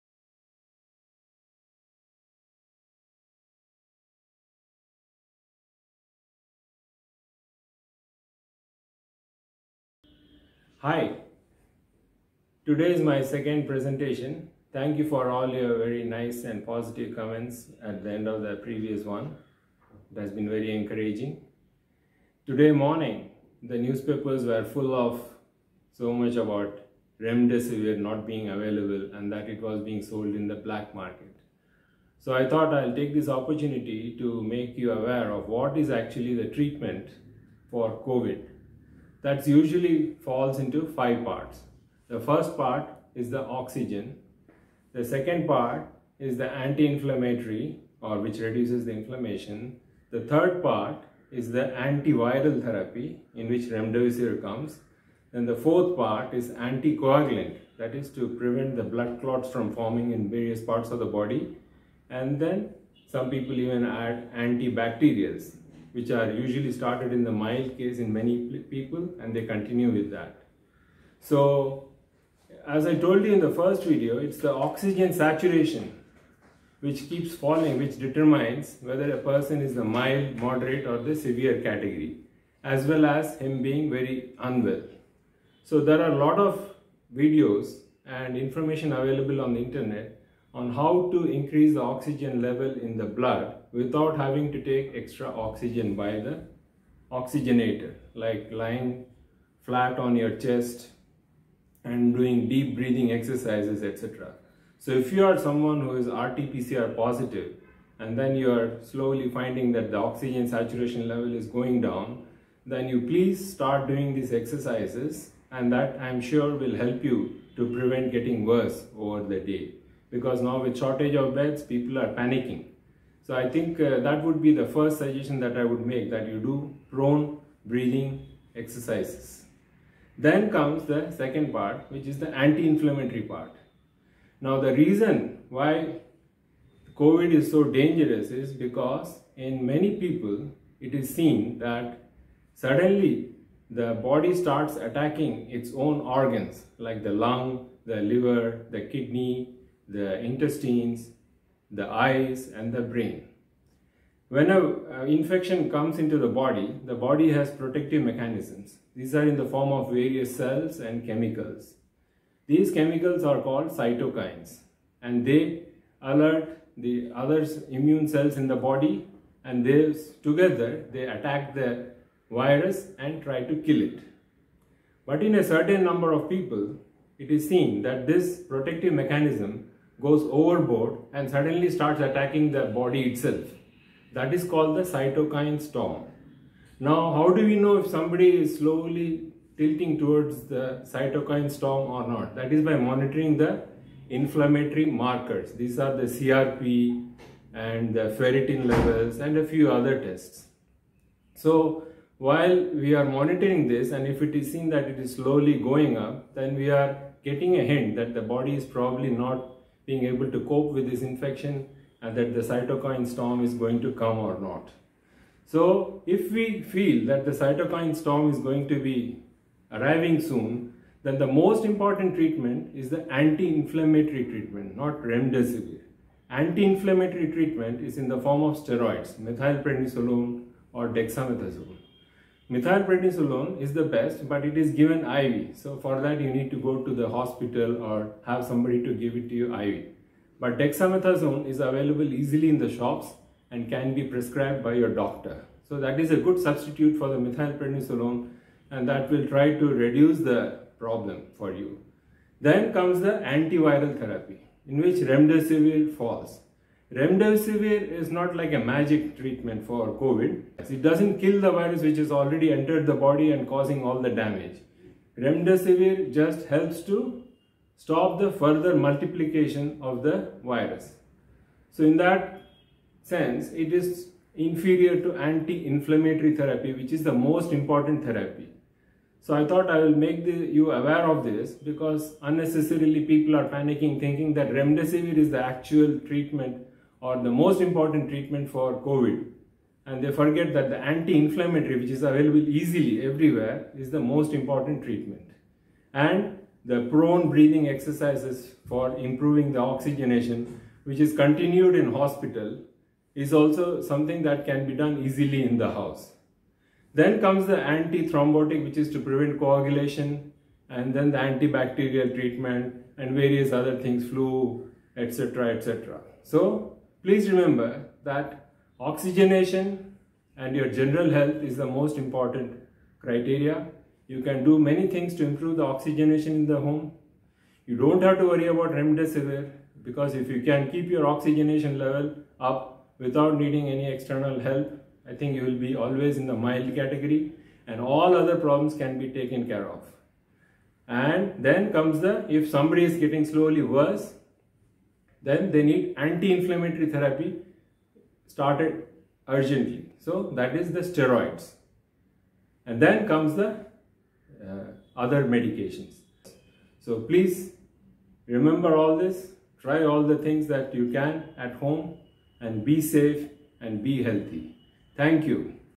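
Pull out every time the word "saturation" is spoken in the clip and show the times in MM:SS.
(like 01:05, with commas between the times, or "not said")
01:15, 01:50.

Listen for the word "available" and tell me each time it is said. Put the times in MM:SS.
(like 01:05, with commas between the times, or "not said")
00:28, 01:28, 04:01, 04:52.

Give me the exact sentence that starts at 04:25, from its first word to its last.
Remdesivir just helps to stop the further multiplication of the virus.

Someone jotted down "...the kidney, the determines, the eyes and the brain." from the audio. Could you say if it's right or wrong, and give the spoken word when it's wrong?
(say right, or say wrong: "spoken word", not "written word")
wrong: "intestines", not "determines".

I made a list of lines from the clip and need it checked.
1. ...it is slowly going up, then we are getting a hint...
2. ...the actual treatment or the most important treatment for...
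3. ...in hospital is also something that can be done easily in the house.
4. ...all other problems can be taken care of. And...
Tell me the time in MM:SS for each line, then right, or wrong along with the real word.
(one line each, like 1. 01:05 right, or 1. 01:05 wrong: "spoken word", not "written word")
1. 03:24 right
2. 04:45 right
3. 05:01 right
4. 05:37 right.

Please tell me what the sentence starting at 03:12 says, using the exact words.
That is by monitoring the inflammatory markers.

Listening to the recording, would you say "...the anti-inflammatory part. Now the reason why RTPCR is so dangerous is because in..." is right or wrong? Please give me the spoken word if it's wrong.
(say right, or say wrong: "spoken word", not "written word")
wrong: "COVID", not "RTPCR".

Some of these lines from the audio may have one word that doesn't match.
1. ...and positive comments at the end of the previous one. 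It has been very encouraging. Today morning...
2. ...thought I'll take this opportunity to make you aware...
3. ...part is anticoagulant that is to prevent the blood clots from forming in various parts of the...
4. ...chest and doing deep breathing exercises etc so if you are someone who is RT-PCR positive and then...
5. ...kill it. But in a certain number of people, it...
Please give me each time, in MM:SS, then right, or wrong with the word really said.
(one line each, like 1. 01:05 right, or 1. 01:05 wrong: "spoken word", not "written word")
1. 00:16 right
2. 00:32 right
3. 00:55 right
4. 01:40 right
5. 02:53 right.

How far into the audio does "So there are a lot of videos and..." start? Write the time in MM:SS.
01:25.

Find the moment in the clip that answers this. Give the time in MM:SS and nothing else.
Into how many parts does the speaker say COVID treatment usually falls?
00:40.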